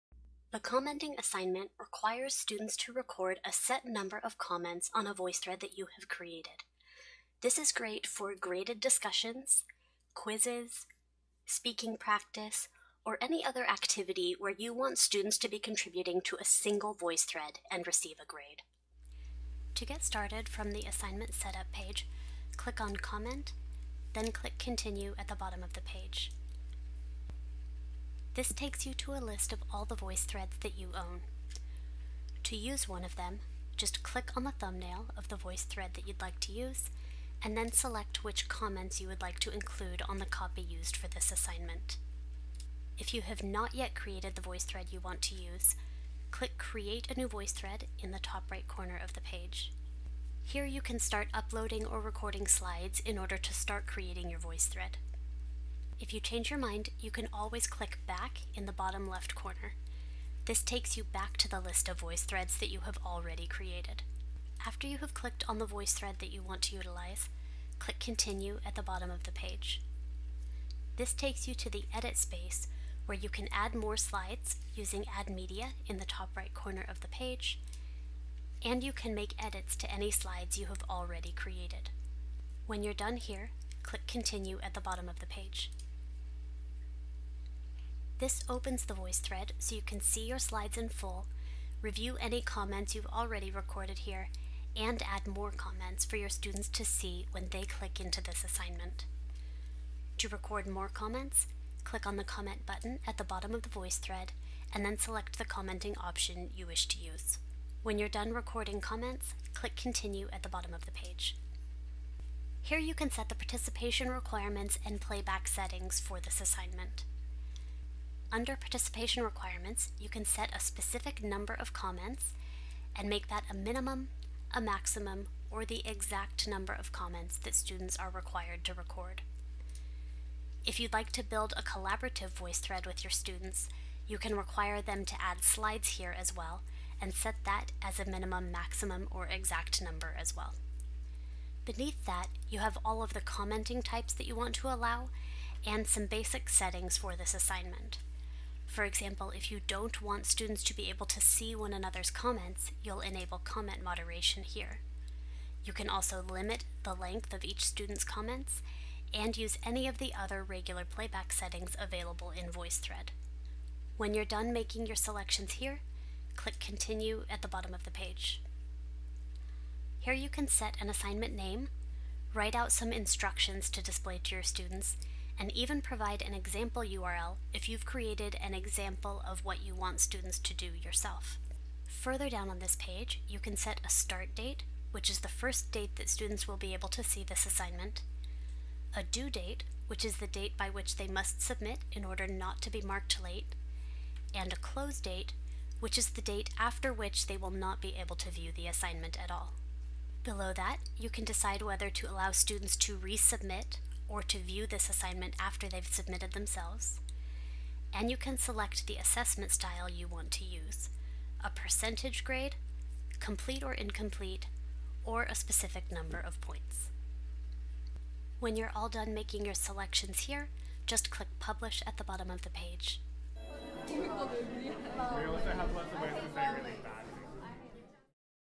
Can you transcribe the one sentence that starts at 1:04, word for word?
After you have clicked on the voice thread that you want to utilize, click Continue at the bottom of the page.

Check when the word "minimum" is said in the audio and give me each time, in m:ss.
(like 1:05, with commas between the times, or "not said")
2:03, 2:18.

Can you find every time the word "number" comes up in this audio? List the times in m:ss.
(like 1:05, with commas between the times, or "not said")
0:03, 2:01, 2:06, 2:19, 3:35.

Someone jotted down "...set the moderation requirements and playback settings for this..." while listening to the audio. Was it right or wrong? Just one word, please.
wrong.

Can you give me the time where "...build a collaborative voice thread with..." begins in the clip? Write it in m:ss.
2:11.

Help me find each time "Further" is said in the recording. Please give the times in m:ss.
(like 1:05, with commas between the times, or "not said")
3:01.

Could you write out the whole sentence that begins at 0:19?
To get started from the assignment setup page, click on Comment, then click Continue at the bottom of the page.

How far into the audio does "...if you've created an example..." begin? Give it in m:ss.
2:57.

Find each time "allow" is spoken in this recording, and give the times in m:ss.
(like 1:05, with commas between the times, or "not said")
2:24, 3:22.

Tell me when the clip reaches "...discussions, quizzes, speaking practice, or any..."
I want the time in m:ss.
0:08.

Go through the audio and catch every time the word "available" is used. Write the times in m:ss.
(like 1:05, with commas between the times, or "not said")
2:41.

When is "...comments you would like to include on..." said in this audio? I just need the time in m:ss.
0:38.